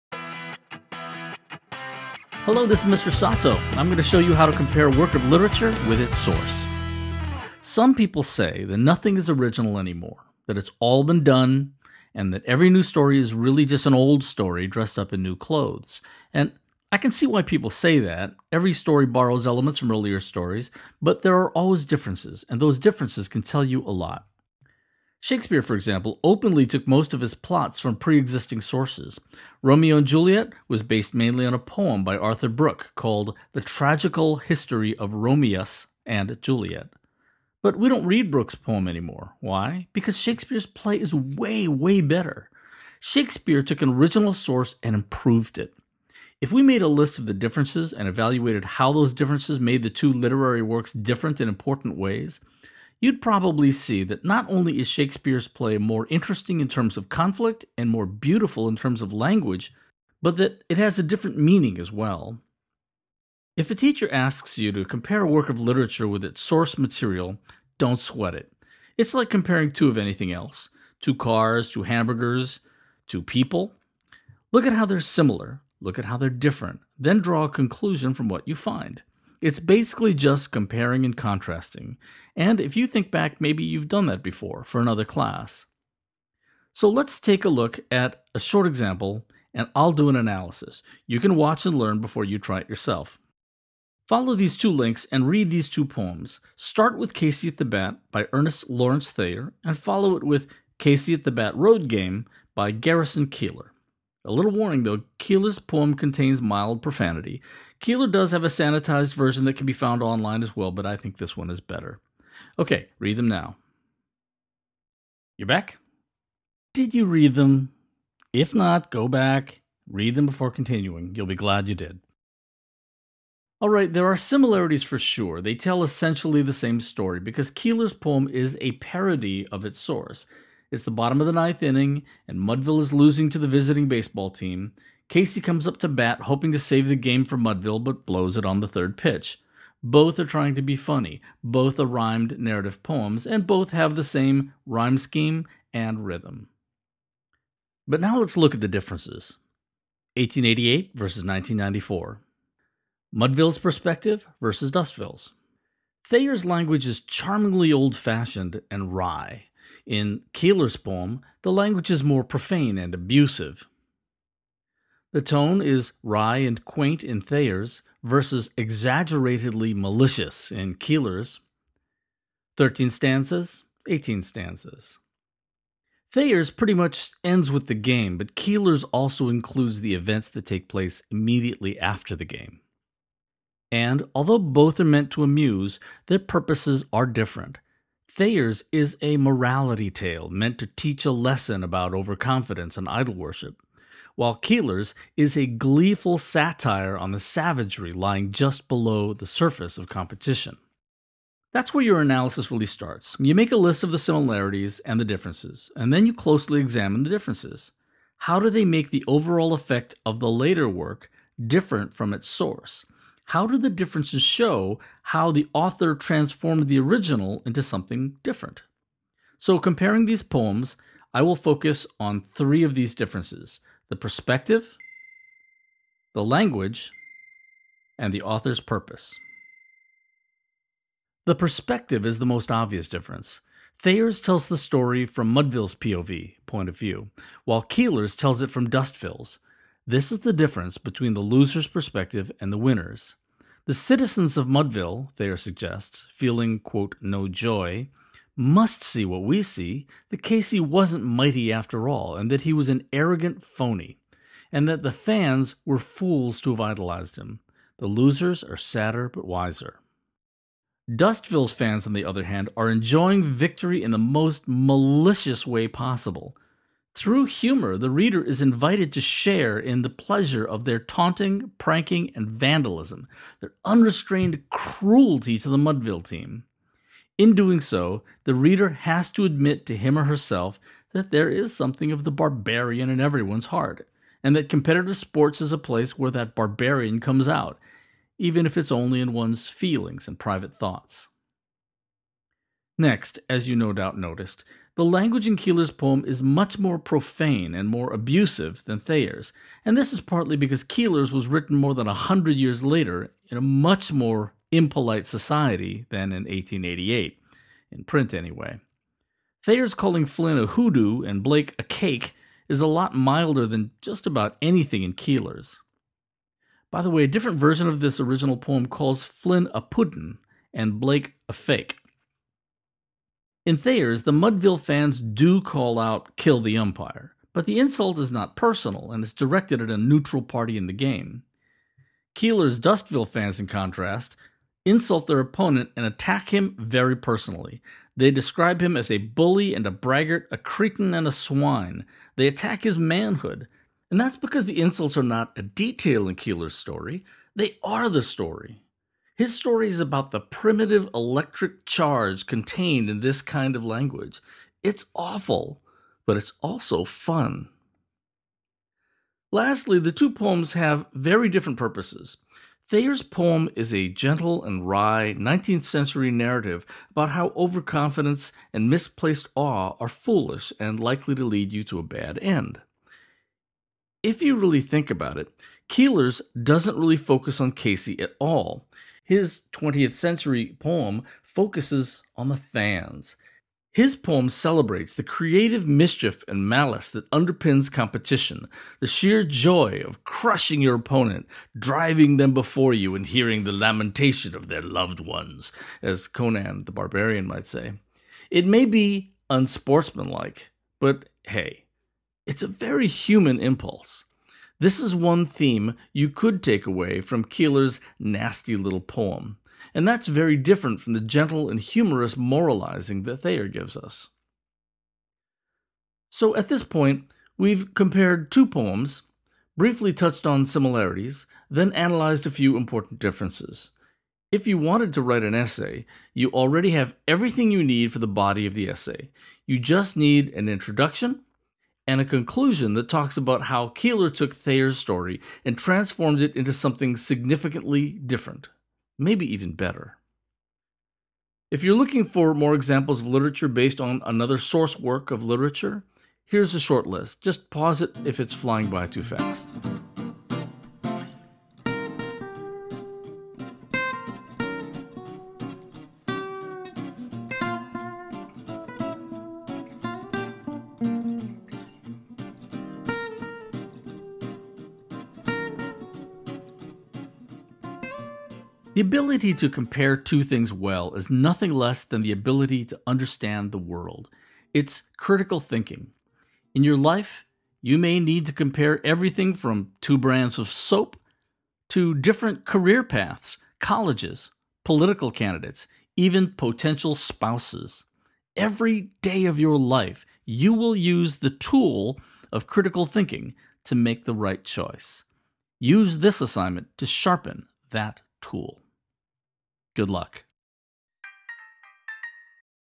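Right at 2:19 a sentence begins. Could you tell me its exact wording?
Both are trying to be funny, both are rhymed narrative poems, and both have the same rhyme scheme and rhythm.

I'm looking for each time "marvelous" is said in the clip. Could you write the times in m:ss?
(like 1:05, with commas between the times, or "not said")
not said.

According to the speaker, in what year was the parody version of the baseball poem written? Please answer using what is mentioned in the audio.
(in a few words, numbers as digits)
1994.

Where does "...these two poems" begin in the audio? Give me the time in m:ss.
1:35.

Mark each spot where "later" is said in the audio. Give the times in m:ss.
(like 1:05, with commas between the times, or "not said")
3:30, 5:02.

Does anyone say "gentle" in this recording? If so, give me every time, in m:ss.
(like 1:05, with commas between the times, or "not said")
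6:03, 6:51.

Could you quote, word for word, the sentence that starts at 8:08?
Every day of your life, you will use the tool of critical thinking to make the right choice.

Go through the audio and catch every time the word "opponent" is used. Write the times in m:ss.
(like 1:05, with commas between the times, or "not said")
5:35, 6:30.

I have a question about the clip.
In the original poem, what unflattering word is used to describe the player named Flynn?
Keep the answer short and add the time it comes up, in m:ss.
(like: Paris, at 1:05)
hoodoo, at 5:10.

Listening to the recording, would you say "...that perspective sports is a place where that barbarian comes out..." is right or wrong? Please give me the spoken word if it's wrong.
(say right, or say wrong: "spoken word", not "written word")
wrong: "competitive", not "perspective".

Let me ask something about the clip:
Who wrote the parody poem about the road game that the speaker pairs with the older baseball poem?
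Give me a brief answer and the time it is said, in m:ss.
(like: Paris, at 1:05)
Garrison Keillor, at 1:42.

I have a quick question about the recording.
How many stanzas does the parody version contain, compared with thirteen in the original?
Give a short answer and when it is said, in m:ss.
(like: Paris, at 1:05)
18, at 2:53.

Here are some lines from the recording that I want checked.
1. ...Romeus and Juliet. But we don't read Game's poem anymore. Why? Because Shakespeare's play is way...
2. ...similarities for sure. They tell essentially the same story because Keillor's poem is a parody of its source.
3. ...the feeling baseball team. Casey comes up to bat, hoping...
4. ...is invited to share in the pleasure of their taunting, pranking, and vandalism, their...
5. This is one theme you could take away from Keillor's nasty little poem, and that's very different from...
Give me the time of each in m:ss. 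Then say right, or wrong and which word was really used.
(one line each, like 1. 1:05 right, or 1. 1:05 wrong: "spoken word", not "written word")
1. 0:35 wrong: "Brooke", not "Game"
2. 2:04 right
3. 2:13 wrong: "visiting", not "feeling"
4. 4:28 right
5. 6:44 right.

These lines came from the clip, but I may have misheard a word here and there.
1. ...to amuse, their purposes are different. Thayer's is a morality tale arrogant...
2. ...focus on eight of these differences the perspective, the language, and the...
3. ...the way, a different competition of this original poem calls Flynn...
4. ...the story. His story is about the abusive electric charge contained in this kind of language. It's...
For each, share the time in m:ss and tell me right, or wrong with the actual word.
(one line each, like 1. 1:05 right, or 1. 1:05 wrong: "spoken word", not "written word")
1. 3:05 wrong: "meant", not "arrogant"
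2. 3:41 wrong: "three", not "eight"
3. 5:16 wrong: "version", not "competition"
4. 5:47 wrong: "primitive", not "abusive".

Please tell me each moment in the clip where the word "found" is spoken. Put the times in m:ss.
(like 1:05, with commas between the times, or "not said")
1:49.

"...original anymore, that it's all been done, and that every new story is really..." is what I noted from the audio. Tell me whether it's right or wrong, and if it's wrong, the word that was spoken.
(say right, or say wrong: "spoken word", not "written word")
right.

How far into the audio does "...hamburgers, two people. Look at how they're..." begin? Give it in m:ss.
1:11.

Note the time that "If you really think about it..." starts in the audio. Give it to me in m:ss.
6:14.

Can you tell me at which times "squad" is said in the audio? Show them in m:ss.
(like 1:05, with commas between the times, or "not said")
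not said.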